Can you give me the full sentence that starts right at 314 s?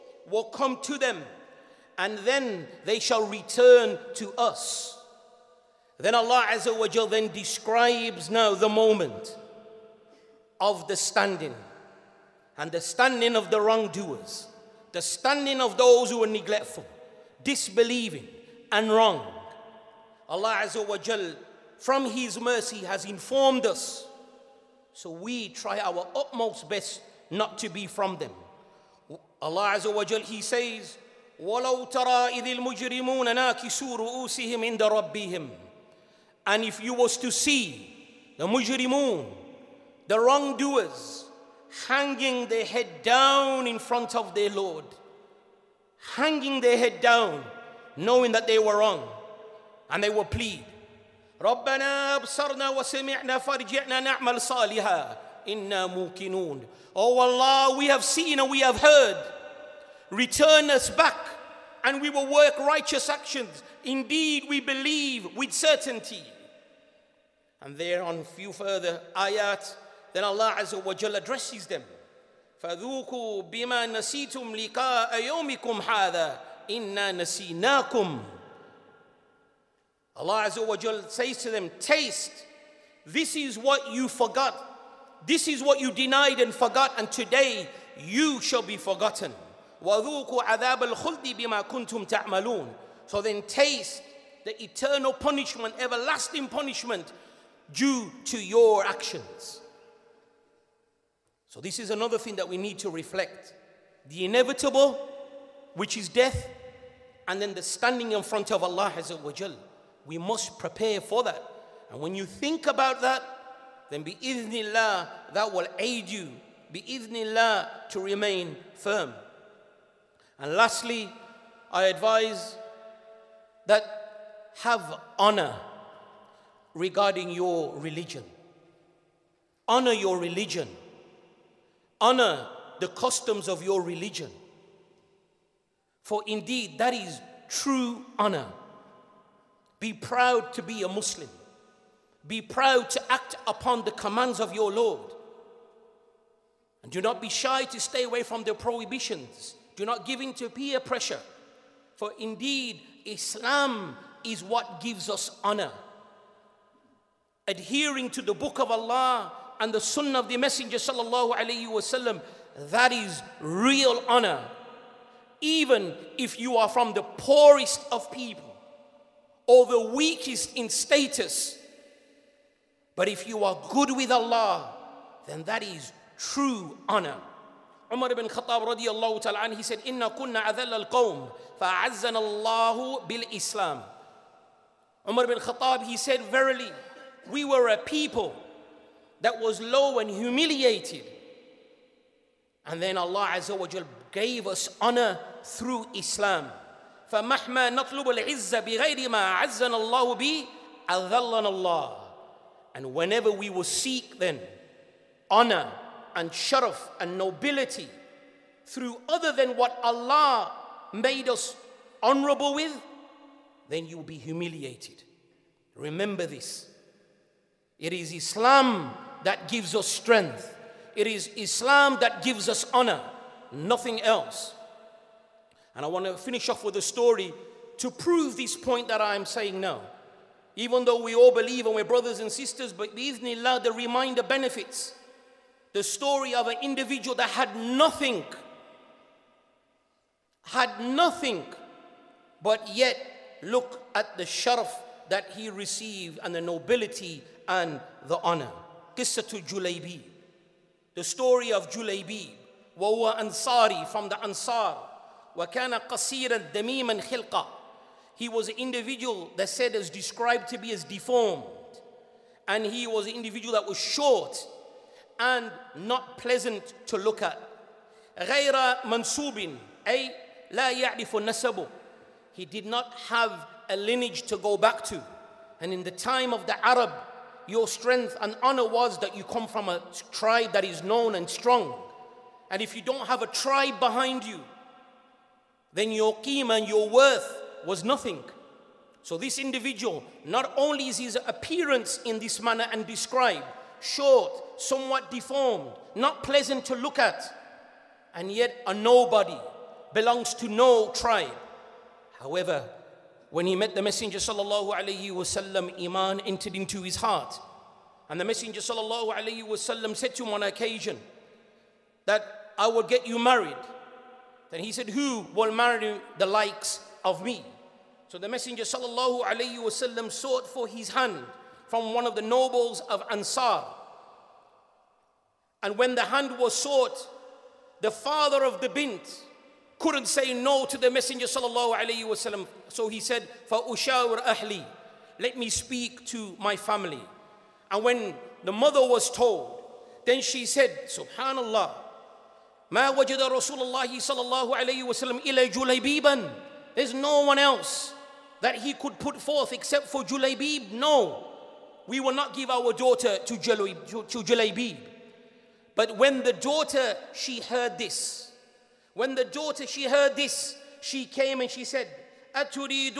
Then he said, Who will marry the likes of me?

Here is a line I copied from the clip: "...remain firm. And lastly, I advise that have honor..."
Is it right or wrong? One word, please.
right.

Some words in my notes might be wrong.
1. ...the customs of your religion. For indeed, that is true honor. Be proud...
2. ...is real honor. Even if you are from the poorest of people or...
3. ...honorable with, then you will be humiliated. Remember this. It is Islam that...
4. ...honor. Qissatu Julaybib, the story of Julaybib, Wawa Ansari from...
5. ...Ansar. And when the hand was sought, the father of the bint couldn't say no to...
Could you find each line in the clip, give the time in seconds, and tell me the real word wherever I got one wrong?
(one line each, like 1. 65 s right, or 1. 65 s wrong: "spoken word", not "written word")
1. 132 s right
2. 162 s right
3. 212 s right
4. 248 s right
5. 323 s right.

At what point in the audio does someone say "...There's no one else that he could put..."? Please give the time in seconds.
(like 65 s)
346 s.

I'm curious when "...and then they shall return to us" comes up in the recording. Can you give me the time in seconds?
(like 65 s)
1 s.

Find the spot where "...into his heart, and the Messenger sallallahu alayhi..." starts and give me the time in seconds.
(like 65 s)
306 s.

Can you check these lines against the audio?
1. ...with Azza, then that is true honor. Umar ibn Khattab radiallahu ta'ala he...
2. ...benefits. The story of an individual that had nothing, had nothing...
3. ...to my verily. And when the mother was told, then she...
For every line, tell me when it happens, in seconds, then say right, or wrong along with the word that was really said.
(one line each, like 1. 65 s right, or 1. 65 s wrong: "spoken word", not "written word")
1. 173 s wrong: "Allah", not "Azza"
2. 234 s right
3. 336 s wrong: "family", not "verily".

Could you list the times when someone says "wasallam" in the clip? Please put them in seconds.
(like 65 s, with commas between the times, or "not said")
161 s, 305 s, 309 s, 319 s, 332 s.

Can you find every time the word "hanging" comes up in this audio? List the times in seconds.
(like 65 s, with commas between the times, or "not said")
41 s, 46 s.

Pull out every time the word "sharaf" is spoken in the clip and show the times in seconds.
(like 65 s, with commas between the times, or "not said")
206 s, 244 s.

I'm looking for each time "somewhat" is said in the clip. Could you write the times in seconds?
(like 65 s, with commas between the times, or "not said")
294 s.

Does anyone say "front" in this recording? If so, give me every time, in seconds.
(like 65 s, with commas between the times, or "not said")
43 s, 108 s.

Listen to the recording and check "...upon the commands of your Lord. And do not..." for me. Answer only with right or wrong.
right.